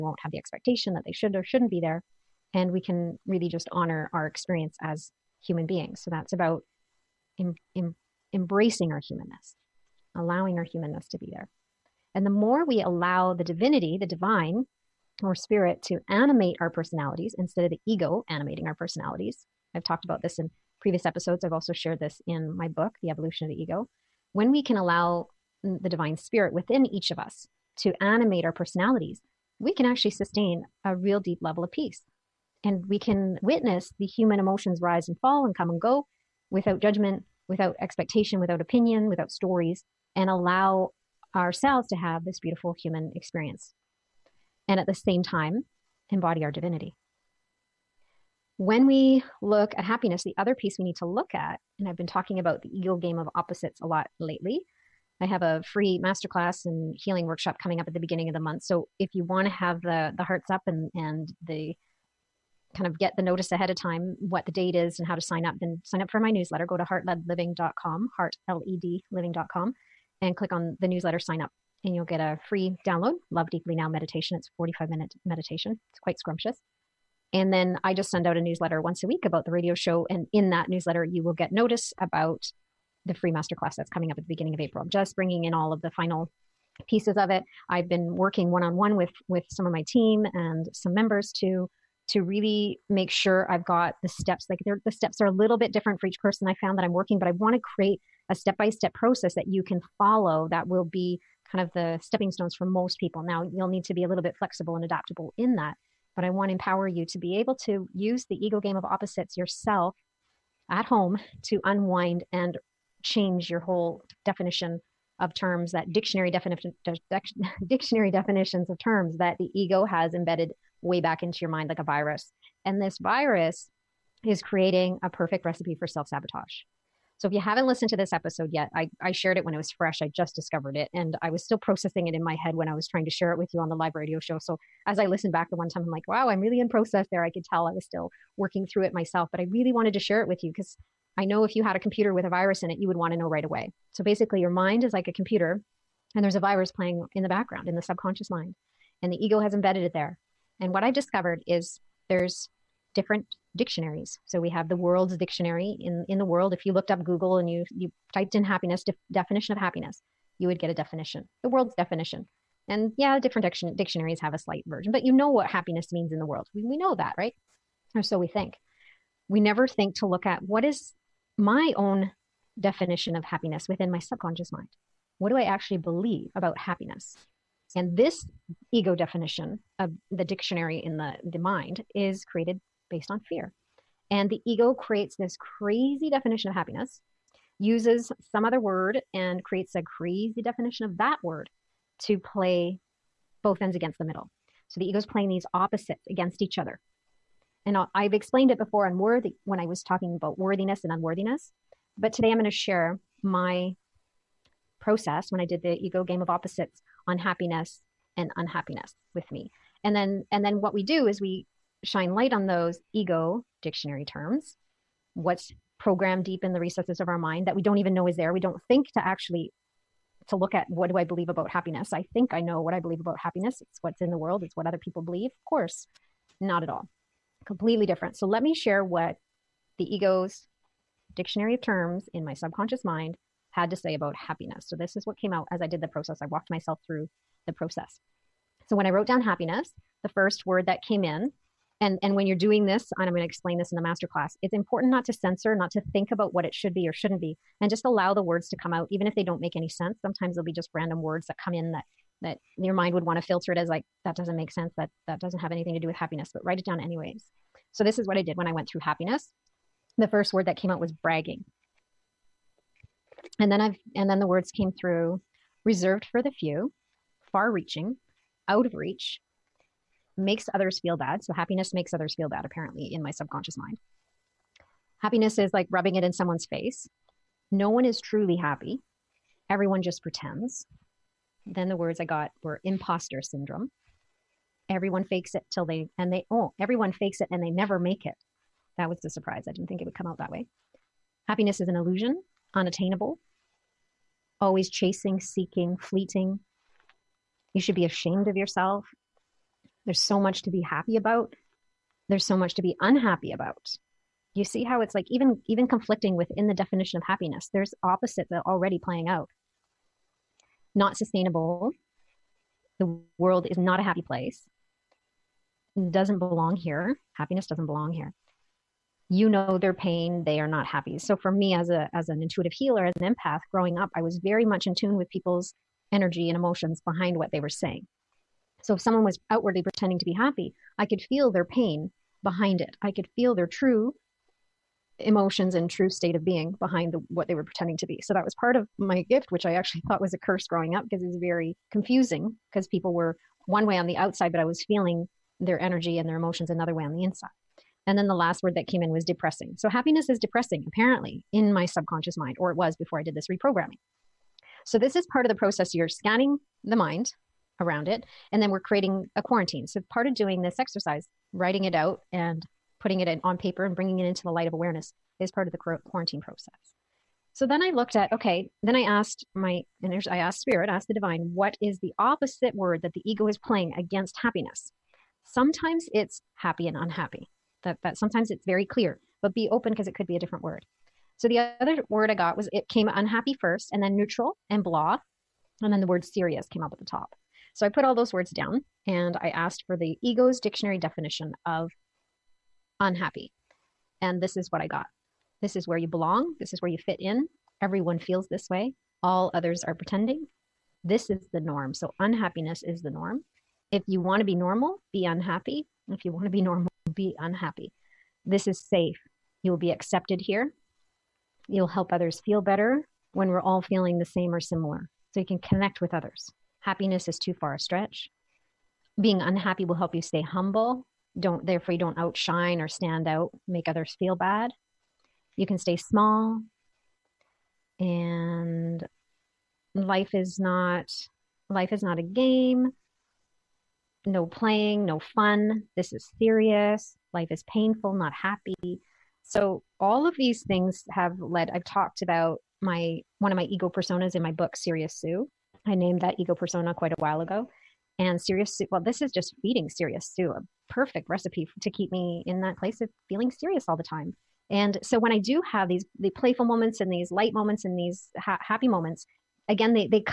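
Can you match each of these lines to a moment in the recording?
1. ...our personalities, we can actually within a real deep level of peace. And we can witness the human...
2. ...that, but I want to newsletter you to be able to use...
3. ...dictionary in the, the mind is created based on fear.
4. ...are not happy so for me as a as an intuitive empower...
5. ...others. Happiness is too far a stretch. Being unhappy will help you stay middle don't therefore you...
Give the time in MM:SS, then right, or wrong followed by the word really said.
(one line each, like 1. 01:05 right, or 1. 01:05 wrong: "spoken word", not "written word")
1. 00:28 wrong: "sustain", not "within"
2. 01:45 wrong: "empower", not "newsletter"
3. 03:00 right
4. 05:20 wrong: "healer", not "empower"
5. 06:55 wrong: "humble", not "middle".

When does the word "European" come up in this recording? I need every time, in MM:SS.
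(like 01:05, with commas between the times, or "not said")
not said.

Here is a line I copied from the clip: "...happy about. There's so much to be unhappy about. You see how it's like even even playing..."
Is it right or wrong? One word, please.
wrong.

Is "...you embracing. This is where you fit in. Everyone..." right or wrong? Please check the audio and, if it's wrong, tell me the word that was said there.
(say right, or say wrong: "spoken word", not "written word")
wrong: "belong", not "embracing".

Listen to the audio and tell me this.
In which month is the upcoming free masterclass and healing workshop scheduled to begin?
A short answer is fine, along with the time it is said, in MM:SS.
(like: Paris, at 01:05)
April, at 01:24.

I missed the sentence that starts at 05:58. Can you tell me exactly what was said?
And then we're creating a quarantine.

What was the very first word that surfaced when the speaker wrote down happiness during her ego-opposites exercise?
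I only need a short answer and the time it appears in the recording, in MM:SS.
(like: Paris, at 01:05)
Bragging, at 04:20.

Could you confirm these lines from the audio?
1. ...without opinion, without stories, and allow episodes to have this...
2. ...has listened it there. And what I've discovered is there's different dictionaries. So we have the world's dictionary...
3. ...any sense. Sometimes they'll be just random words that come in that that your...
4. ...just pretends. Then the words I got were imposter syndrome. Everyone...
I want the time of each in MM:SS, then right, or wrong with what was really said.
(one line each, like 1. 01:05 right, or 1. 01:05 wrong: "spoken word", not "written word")
1. 00:38 wrong: "ourselves", not "episodes"
2. 02:29 wrong: "embedded", not "listened"
3. 04:09 right
4. 04:39 right.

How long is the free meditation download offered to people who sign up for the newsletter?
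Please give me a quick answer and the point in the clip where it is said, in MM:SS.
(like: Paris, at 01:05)
45 minutes, at 01:14.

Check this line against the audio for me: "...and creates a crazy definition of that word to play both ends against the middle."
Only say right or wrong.
right.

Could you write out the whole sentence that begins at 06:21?
So the other word I got was it came unhappy first and then neutral and blah.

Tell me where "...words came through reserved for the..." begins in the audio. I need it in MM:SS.
04:24.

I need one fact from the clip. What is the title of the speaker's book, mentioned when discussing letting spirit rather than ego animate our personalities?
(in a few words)
The Evolution of the Ego.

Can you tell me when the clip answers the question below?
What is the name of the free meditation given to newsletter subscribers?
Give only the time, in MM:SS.
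01:13.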